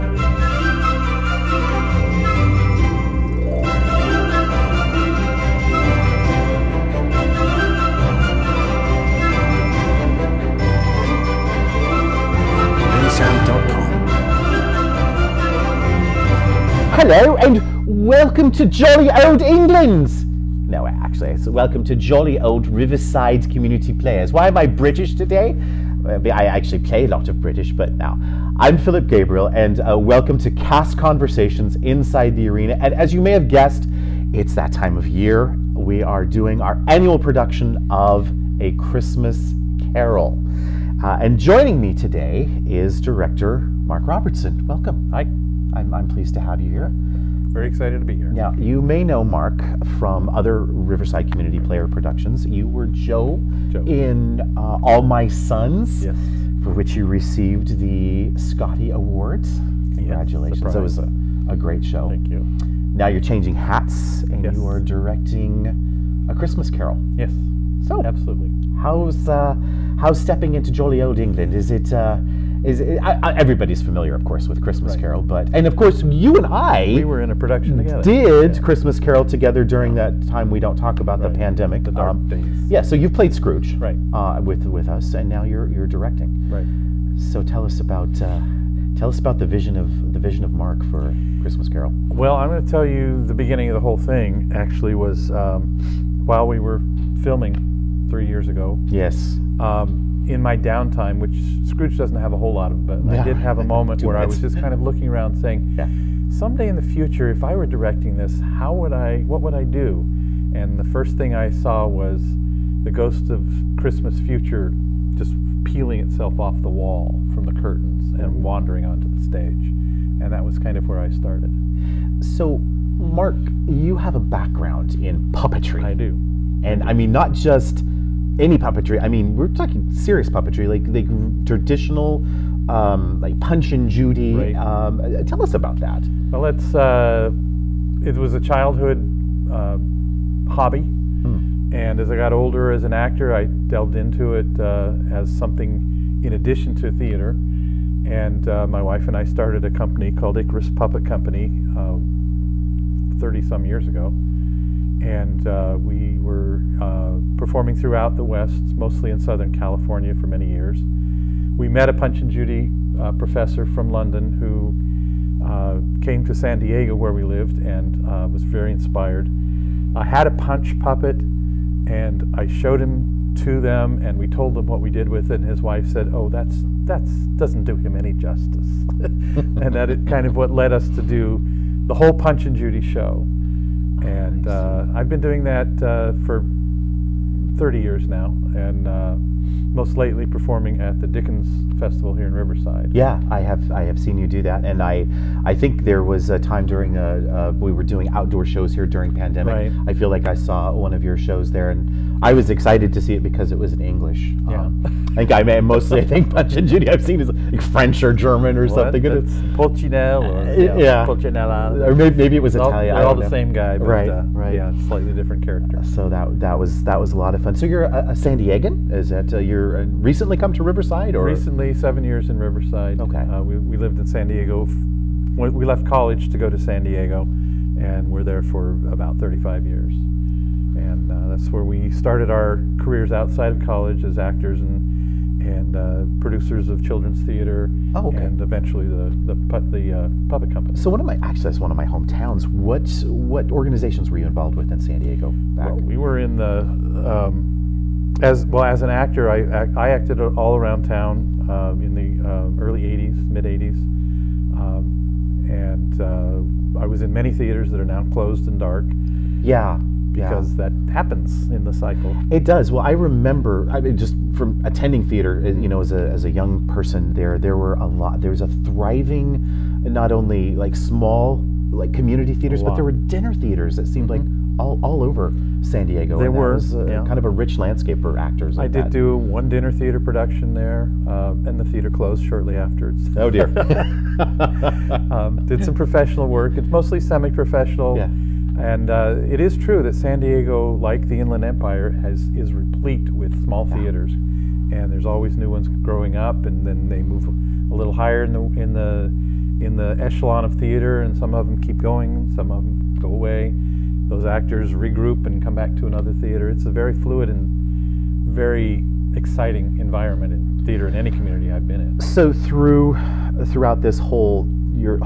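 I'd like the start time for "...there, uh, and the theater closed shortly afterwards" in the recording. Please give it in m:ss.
4:40.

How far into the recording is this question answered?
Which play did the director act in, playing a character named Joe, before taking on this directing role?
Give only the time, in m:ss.
0:54.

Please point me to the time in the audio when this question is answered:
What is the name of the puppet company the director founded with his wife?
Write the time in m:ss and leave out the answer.
2:30.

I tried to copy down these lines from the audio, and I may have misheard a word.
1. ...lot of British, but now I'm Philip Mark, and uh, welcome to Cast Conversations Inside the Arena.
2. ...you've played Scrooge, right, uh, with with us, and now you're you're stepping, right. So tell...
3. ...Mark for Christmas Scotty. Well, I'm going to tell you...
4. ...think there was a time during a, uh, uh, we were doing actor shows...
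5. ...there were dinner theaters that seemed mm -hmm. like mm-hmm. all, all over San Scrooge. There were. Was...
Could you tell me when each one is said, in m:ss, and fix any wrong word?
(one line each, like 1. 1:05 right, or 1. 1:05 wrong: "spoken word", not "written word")
1. 0:27 wrong: "Gabriel", not "Mark"
2. 1:22 wrong: "directing", not "stepping"
3. 1:30 wrong: "Carol", not "Scotty"
4. 3:15 wrong: "outdoor", not "actor"
5. 4:32 wrong: "Diego", not "Scrooge".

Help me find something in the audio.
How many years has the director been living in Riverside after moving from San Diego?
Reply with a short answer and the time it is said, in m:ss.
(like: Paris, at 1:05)
7, at 3:41.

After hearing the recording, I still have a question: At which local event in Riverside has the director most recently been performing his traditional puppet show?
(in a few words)
Dickens Festival.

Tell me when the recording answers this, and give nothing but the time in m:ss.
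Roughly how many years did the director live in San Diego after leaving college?
3:49.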